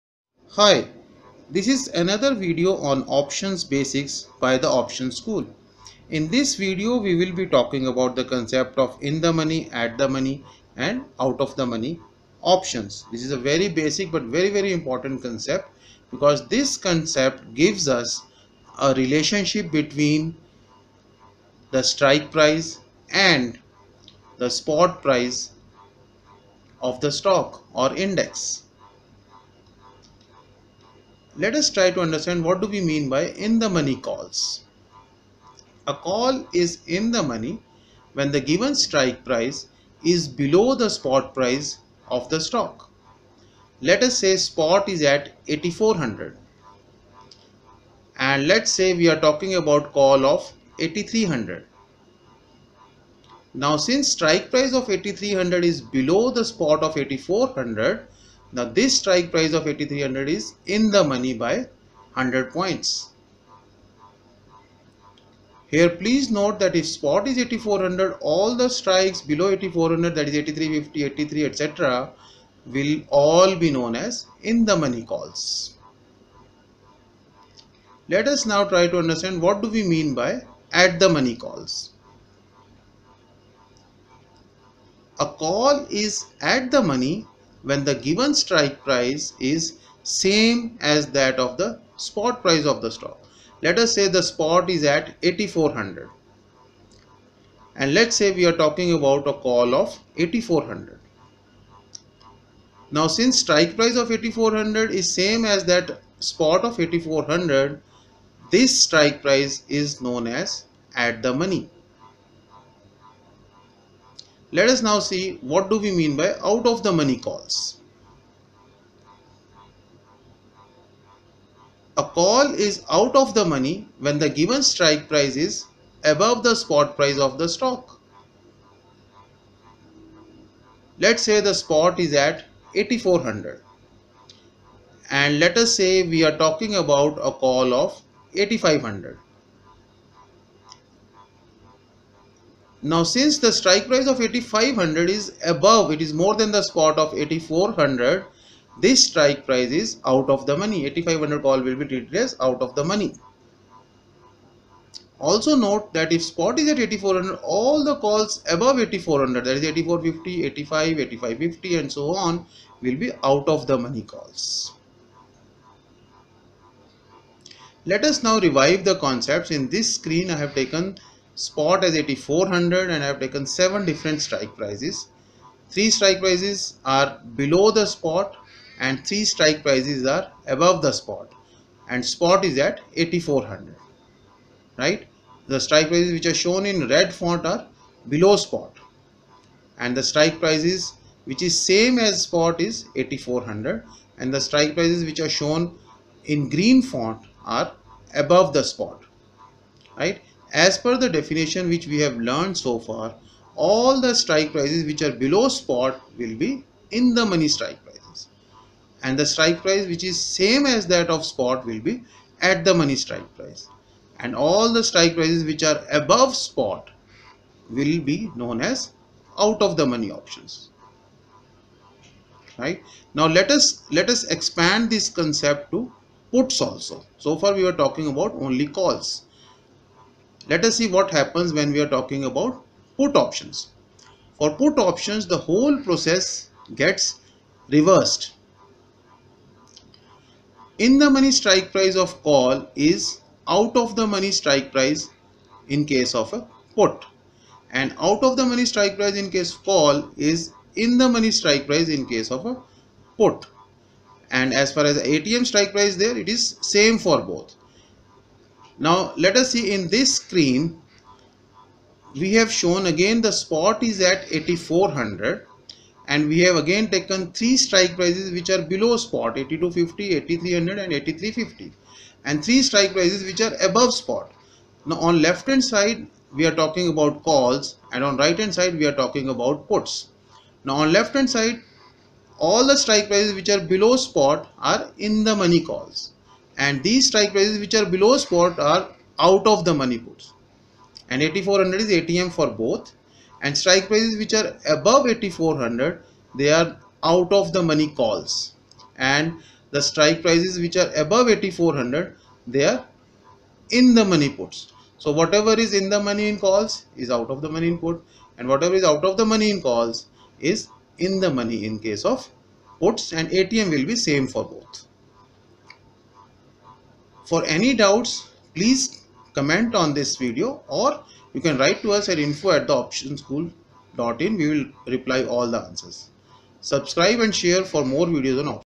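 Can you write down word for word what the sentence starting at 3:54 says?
For put options, the whole process gets reversed.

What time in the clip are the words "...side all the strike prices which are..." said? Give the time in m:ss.
4:41.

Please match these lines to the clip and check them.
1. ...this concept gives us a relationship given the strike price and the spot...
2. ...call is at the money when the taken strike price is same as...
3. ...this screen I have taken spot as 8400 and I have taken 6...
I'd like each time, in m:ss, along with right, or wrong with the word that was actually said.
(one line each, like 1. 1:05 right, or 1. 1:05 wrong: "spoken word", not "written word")
1. 0:16 wrong: "between", not "given"
2. 1:25 wrong: "given", not "taken"
3. 2:49 wrong: "7", not "6".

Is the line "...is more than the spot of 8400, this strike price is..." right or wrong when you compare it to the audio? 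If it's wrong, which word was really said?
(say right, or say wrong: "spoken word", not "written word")
right.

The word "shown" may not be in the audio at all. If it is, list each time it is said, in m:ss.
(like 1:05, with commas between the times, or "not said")
3:06, 3:15, 4:22.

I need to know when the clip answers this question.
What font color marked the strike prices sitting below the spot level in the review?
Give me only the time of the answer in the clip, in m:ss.
3:06.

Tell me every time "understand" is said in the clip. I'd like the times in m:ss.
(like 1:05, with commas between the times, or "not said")
0:32, 1:18.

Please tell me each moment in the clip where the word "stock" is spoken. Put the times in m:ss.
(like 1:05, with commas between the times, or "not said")
0:27, 0:42, 1:32, 2:07.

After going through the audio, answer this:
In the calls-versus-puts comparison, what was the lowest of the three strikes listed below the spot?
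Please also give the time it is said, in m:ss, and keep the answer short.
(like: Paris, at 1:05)
8250, at 4:29.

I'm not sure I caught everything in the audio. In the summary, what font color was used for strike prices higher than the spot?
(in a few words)
Green.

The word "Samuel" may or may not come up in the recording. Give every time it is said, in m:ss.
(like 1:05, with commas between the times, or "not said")
not said.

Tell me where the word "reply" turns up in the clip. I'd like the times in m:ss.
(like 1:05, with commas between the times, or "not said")
5:24.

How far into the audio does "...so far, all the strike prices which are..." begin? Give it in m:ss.
3:22.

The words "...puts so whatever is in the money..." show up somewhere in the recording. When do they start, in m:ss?
5:04.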